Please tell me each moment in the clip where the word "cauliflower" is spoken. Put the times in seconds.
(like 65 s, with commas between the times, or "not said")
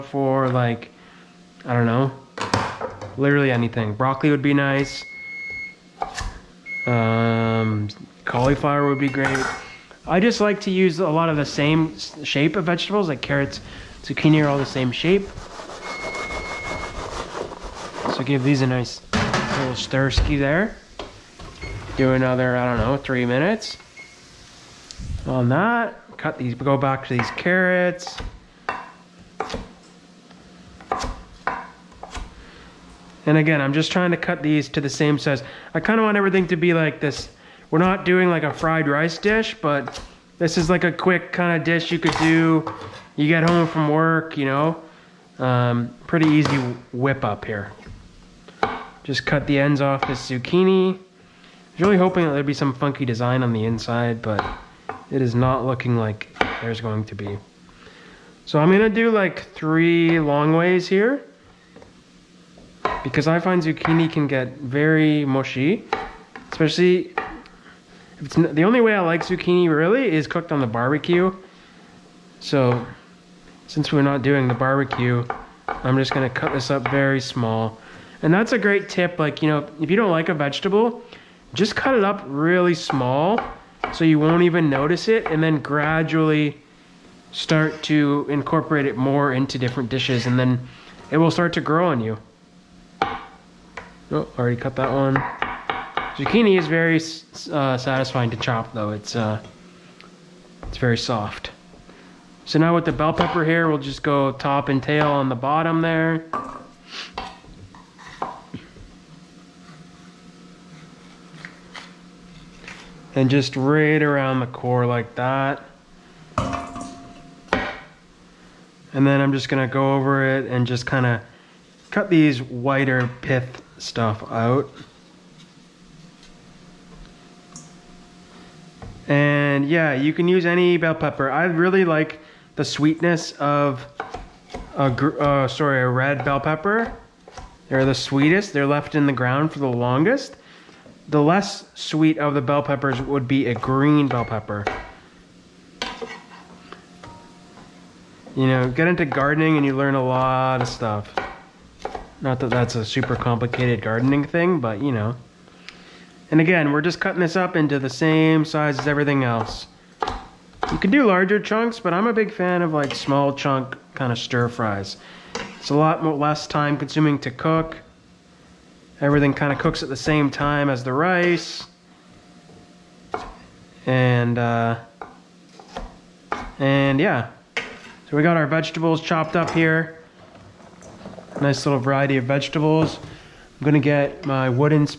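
8 s.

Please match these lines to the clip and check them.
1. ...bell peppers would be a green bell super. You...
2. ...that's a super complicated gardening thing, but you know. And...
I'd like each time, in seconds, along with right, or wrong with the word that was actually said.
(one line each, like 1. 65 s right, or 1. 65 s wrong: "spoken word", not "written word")
1. 142 s wrong: "pepper", not "super"
2. 152 s right.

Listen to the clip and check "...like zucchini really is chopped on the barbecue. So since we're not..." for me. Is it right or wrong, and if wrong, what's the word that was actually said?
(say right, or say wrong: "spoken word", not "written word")
wrong: "cooked", not "chopped".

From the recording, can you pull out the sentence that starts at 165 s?
It's a lot more, less time consuming to cook.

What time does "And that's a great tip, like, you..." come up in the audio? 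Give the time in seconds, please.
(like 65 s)
78 s.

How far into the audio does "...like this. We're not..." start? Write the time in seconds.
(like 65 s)
36 s.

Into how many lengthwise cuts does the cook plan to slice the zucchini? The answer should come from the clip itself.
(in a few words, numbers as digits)
3.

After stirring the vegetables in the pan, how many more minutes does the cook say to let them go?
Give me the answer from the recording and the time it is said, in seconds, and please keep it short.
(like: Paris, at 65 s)
3, at 22 s.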